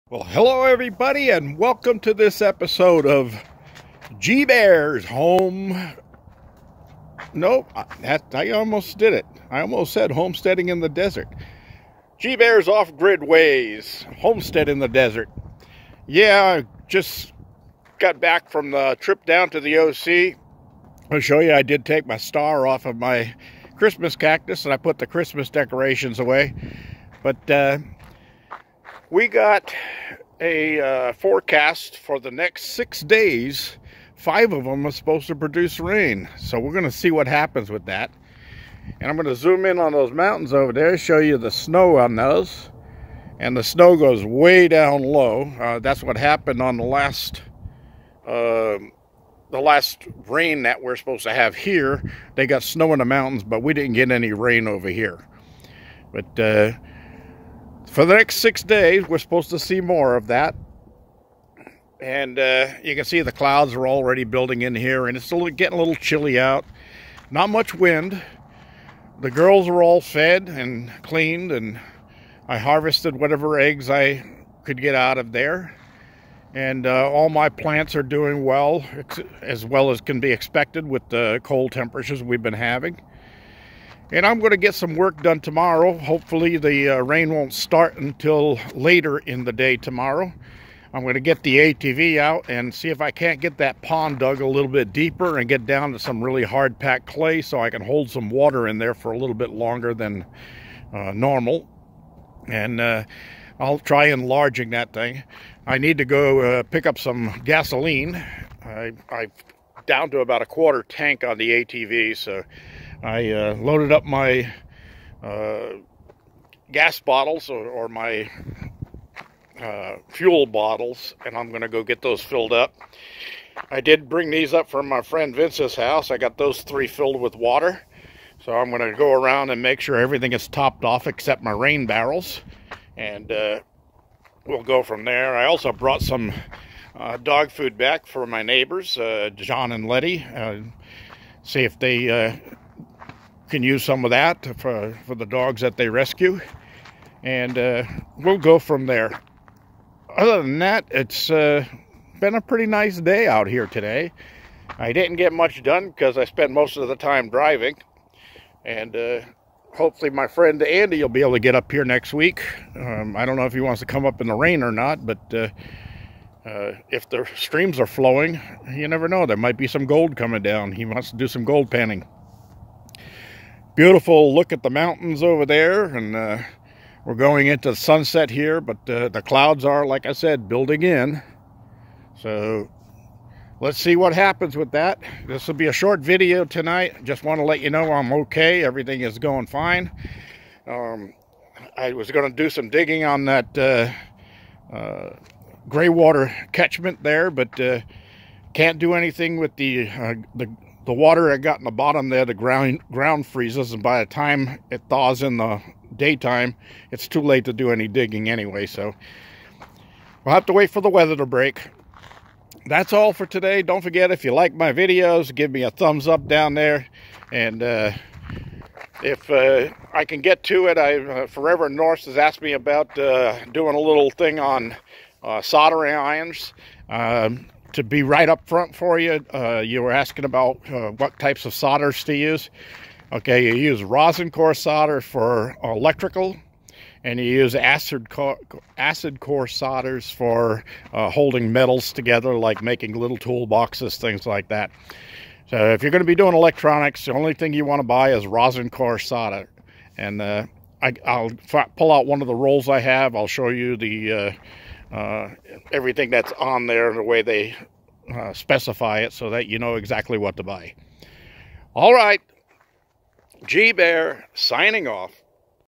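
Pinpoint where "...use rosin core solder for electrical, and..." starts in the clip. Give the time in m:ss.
3:53.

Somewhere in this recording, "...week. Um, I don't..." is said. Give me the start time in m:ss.
2:42.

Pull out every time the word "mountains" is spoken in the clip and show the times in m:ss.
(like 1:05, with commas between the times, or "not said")
0:40, 0:53, 2:54.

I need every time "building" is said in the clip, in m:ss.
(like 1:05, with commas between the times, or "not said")
1:04, 3:00.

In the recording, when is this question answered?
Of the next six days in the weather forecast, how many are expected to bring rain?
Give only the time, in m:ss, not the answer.
0:34.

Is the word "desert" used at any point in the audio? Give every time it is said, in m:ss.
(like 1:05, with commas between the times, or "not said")
0:10, 0:14.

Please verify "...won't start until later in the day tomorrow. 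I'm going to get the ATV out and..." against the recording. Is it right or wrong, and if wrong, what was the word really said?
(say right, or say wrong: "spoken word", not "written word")
right.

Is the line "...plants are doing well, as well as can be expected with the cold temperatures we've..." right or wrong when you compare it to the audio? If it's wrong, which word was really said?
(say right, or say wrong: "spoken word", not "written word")
right.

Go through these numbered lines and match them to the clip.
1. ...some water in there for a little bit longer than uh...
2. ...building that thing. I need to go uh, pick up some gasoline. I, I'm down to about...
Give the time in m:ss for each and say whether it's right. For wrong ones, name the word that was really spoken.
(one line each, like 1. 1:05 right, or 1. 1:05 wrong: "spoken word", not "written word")
1. 1:38 right
2. 1:44 wrong: "enlarging", not "building".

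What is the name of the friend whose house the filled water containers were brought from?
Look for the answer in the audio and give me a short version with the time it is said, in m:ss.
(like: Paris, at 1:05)
Vince, at 2:05.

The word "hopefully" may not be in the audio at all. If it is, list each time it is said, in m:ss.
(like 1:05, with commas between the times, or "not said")
1:25, 2:39.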